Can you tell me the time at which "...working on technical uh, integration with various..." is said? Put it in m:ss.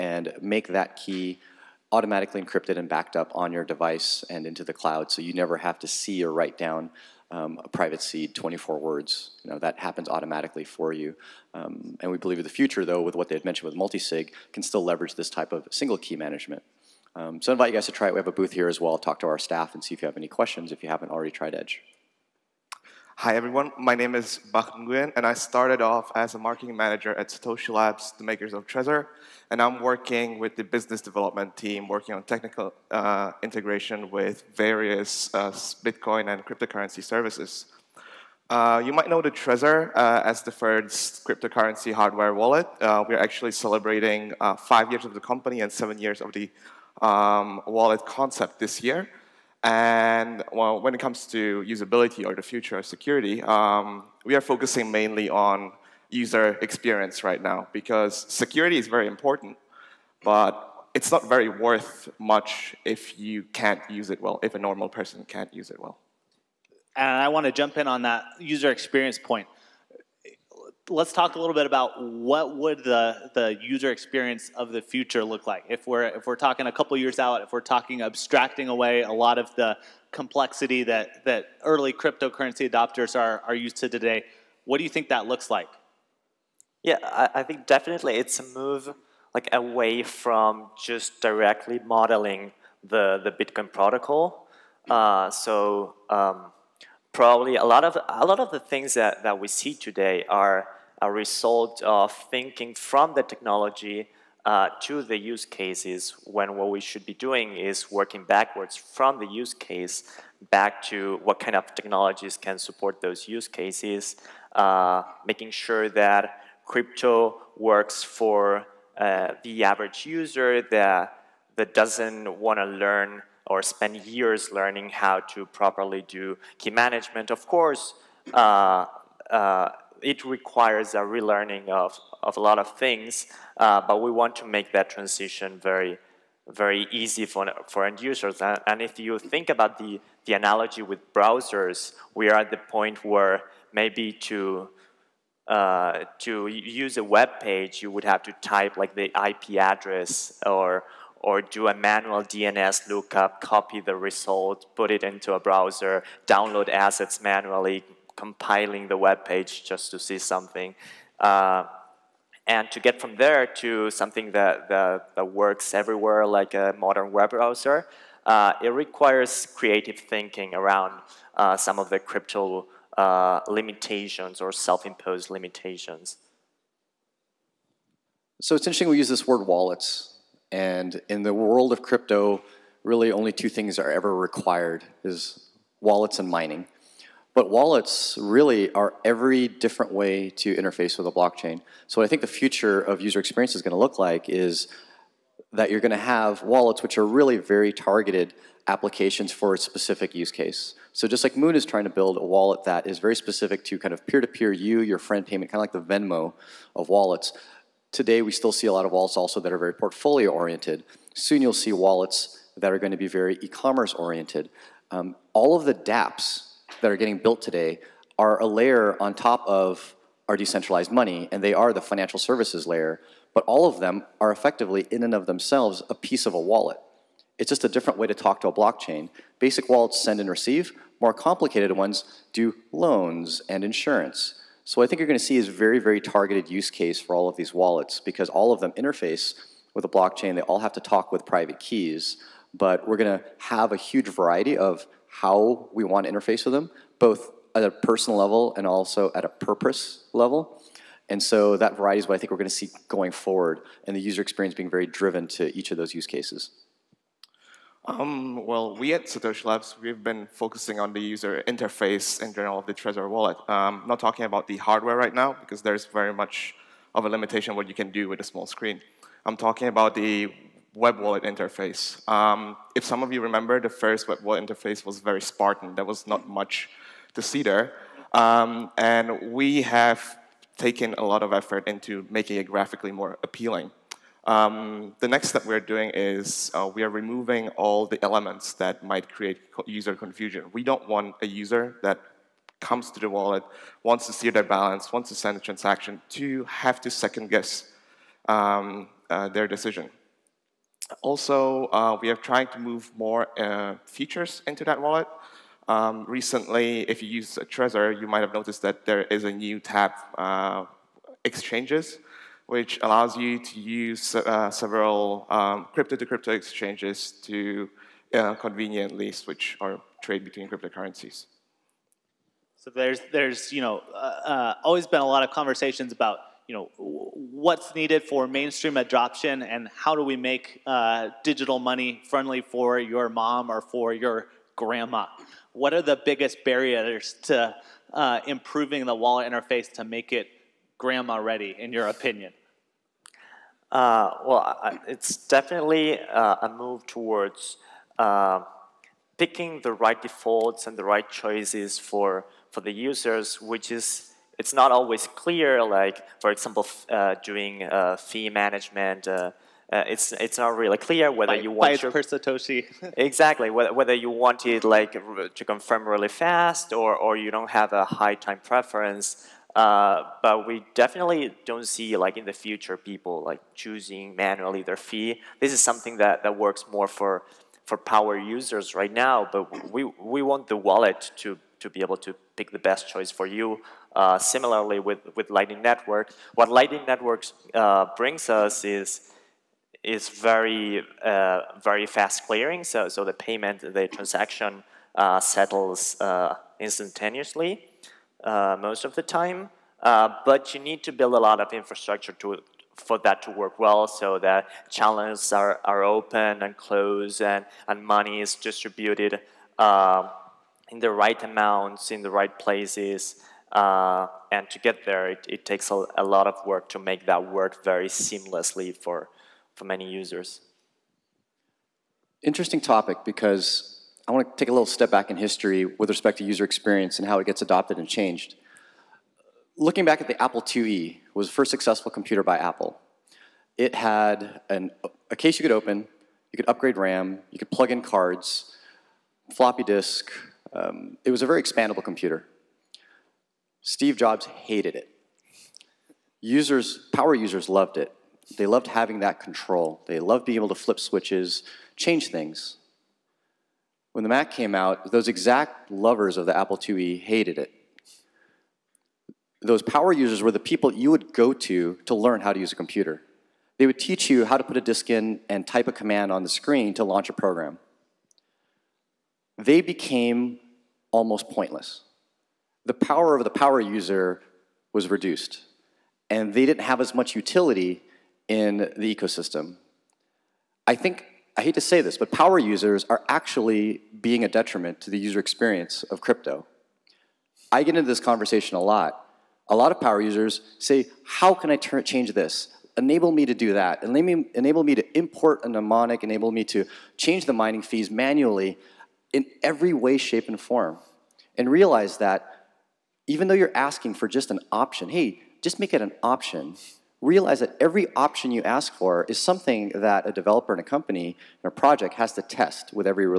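0:31.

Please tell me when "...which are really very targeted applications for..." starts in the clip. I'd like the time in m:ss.
3:16.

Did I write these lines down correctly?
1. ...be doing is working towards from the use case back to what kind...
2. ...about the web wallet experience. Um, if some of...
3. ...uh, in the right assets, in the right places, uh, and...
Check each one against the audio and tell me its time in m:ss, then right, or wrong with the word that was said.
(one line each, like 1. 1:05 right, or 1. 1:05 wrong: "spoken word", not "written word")
1. 1:47 wrong: "backwards", not "towards"
2. 4:29 wrong: "interface", not "experience"
3. 6:49 wrong: "amounts", not "assets".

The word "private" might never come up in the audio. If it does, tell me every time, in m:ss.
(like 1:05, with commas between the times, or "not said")
0:07, 4:01.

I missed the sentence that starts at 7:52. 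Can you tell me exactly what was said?
The power of the power user was reduced, and they didn't have as much utility in the ecosystem.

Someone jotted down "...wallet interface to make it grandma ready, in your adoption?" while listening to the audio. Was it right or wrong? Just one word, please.
wrong.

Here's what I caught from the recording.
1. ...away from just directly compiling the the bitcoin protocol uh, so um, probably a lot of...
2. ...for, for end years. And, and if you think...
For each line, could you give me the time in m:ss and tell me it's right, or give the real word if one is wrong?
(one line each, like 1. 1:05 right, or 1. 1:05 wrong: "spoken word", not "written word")
1. 1:29 wrong: "modeling", not "compiling"
2. 2:17 wrong: "users", not "years".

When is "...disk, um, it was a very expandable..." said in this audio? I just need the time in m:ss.
7:19.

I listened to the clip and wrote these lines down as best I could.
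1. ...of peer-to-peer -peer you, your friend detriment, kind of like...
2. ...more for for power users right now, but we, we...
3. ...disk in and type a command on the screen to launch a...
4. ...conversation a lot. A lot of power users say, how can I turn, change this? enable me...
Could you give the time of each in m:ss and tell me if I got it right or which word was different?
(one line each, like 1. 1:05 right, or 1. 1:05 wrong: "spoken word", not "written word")
1. 3:23 wrong: "payment", not "detriment"
2. 6:16 right
3. 7:44 right
4. 8:07 right.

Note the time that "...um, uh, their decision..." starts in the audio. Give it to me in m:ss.
4:58.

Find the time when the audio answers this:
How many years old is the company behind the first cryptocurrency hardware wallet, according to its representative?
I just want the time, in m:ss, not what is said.
0:44.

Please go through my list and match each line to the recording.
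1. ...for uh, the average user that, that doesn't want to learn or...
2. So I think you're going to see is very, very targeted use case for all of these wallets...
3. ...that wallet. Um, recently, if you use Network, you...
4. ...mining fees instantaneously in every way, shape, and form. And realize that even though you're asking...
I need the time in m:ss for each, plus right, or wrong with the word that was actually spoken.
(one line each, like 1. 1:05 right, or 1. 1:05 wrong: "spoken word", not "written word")
1. 1:58 right
2. 3:54 right
3. 5:04 wrong: "Trezor", not "Network"
4. 8:17 wrong: "manually", not "instantaneously".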